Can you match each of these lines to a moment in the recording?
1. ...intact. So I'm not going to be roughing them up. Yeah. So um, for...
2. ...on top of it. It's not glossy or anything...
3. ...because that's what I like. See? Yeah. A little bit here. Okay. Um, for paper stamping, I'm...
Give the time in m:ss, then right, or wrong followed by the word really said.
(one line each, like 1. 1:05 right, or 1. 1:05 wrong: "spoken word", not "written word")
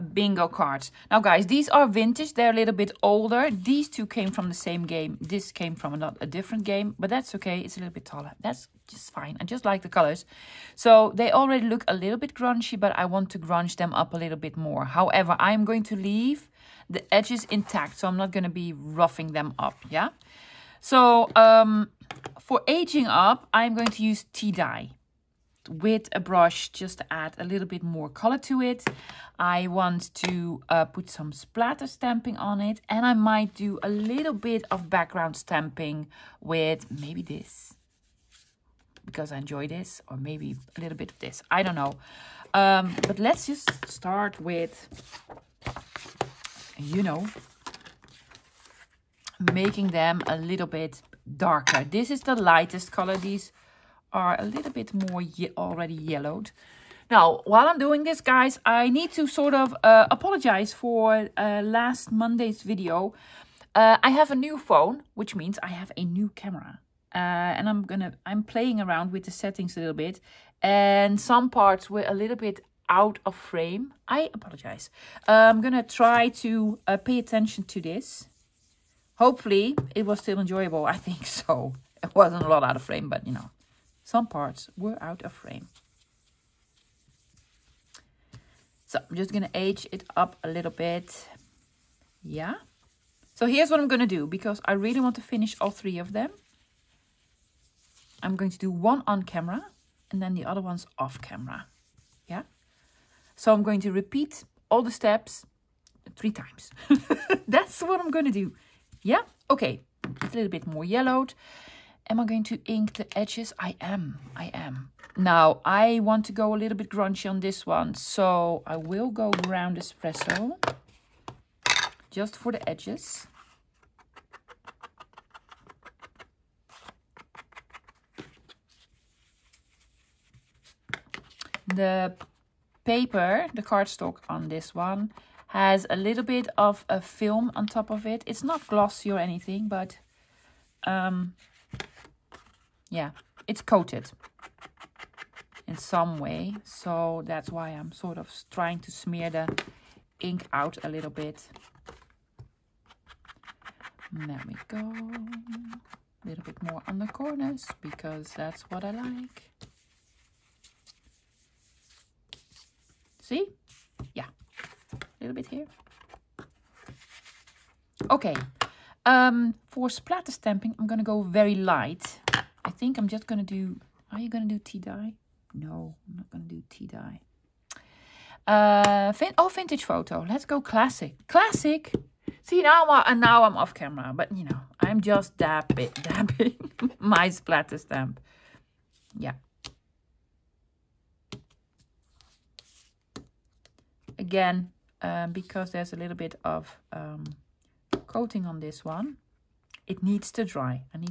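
1. 0:17 right
2. 2:17 right
3. 2:37 wrong: "splatter", not "paper".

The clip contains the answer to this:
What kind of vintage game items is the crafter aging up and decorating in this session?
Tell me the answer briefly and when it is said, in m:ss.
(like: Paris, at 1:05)
bingo cards, at 0:00.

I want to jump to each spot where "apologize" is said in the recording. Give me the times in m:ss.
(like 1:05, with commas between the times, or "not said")
1:00, 1:14.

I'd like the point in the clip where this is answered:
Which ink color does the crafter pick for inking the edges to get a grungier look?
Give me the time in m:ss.
1:59.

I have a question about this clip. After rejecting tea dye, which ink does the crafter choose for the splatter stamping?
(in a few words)
vintage photo.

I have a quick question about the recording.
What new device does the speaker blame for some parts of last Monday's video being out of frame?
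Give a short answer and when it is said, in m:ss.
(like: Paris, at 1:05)
phone, at 1:04.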